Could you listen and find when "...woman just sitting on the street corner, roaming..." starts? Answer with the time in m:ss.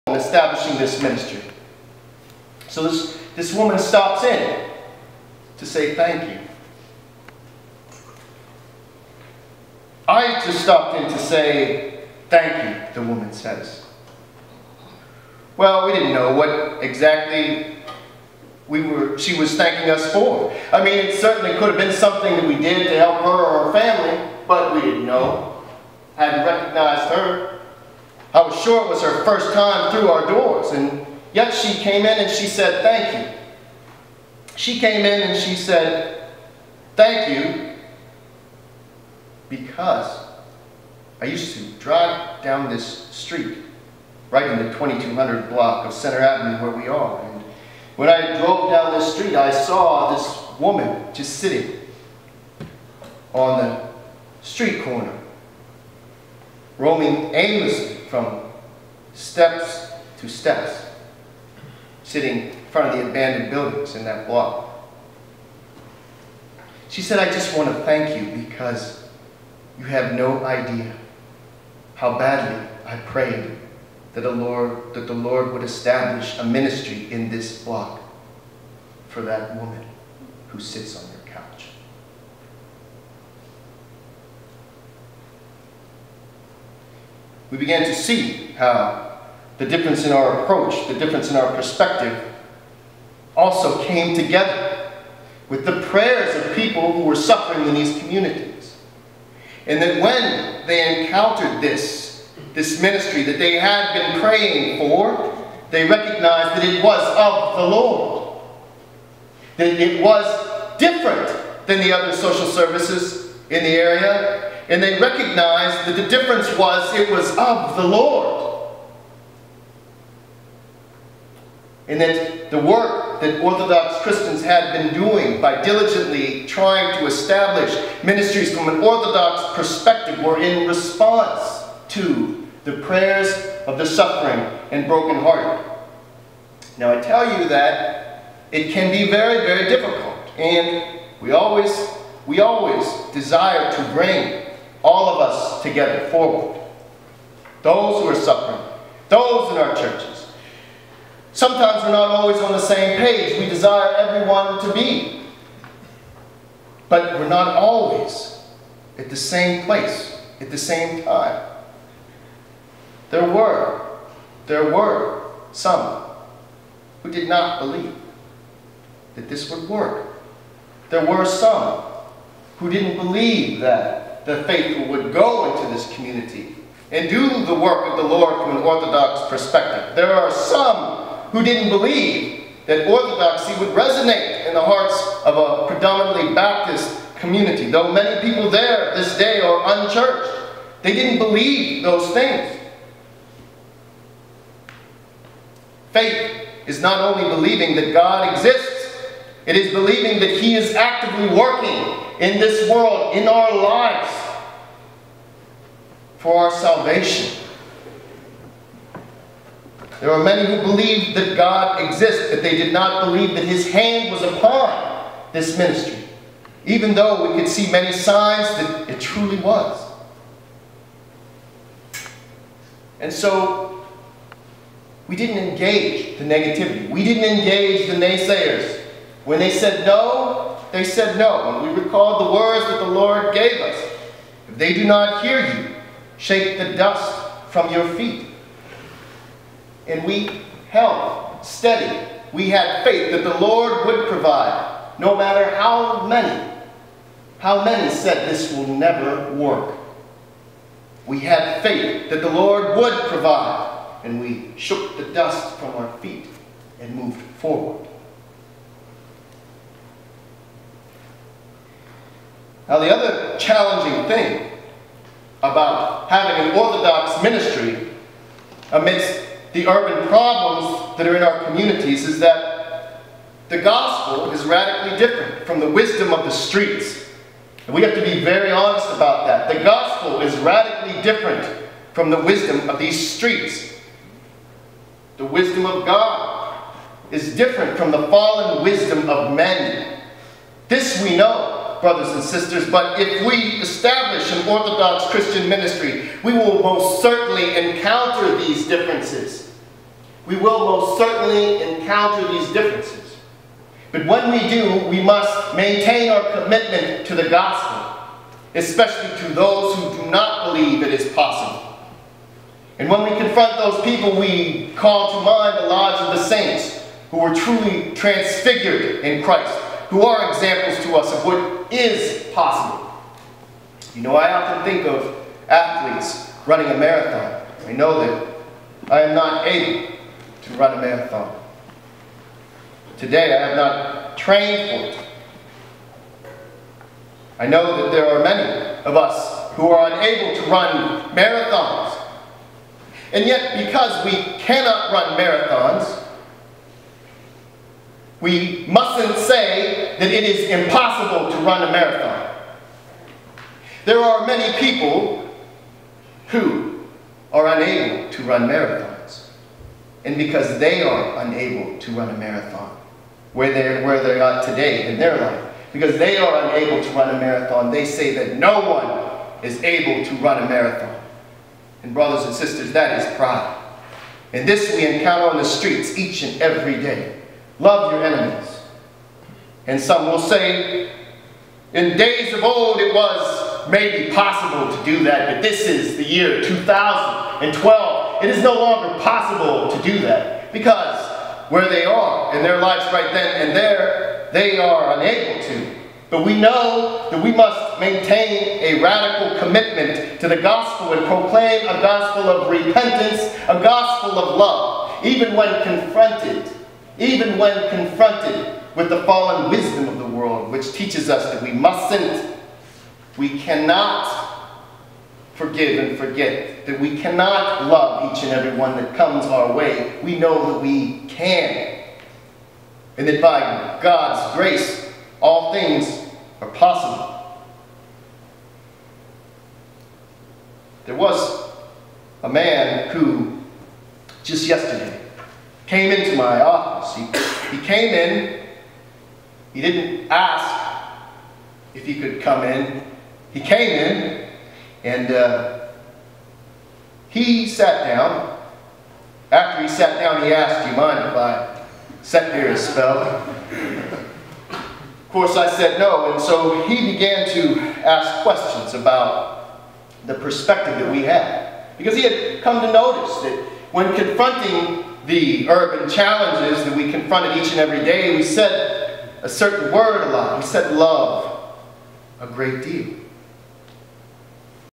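0:50.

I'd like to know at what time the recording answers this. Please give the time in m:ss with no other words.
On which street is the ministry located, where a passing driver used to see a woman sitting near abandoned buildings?
0:45.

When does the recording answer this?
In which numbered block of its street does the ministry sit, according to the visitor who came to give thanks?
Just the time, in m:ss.
0:44.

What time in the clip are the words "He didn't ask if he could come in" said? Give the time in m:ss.
7:19.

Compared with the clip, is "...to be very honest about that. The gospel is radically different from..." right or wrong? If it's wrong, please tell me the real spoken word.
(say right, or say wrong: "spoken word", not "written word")
right.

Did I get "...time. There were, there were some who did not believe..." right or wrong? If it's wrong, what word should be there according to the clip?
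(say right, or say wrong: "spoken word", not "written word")
right.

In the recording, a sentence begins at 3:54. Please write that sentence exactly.
If they do not hear you, shake the dust from your feet.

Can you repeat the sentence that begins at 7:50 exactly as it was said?
We said love a great deal.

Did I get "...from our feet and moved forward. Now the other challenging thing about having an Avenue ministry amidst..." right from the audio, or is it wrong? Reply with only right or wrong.
wrong.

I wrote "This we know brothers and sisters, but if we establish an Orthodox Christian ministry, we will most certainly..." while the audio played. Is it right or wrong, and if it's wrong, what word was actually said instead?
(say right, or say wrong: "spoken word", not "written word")
right.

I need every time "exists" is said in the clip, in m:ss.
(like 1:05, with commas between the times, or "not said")
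3:18, 3:31.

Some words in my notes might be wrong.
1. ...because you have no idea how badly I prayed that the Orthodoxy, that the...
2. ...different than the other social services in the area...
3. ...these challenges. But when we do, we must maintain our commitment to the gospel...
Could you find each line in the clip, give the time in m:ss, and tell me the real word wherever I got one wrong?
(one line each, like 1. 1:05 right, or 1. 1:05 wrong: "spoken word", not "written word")
1. 1:08 wrong: "Lord", not "Orthodoxy"
2. 1:50 right
3. 5:02 wrong: "differences", not "challenges".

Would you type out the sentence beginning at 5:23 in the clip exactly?
You know, I often think of athletes running a marathon.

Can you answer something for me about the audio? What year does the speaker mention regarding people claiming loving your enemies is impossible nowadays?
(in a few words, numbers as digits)
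2012.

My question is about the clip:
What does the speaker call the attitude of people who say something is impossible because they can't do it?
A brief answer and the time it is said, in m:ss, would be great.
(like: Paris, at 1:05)
Pride, at 6:13.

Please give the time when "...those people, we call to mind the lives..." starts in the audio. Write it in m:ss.
5:13.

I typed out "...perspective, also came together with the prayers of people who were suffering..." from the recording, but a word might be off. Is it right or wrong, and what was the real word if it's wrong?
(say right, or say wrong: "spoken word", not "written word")
right.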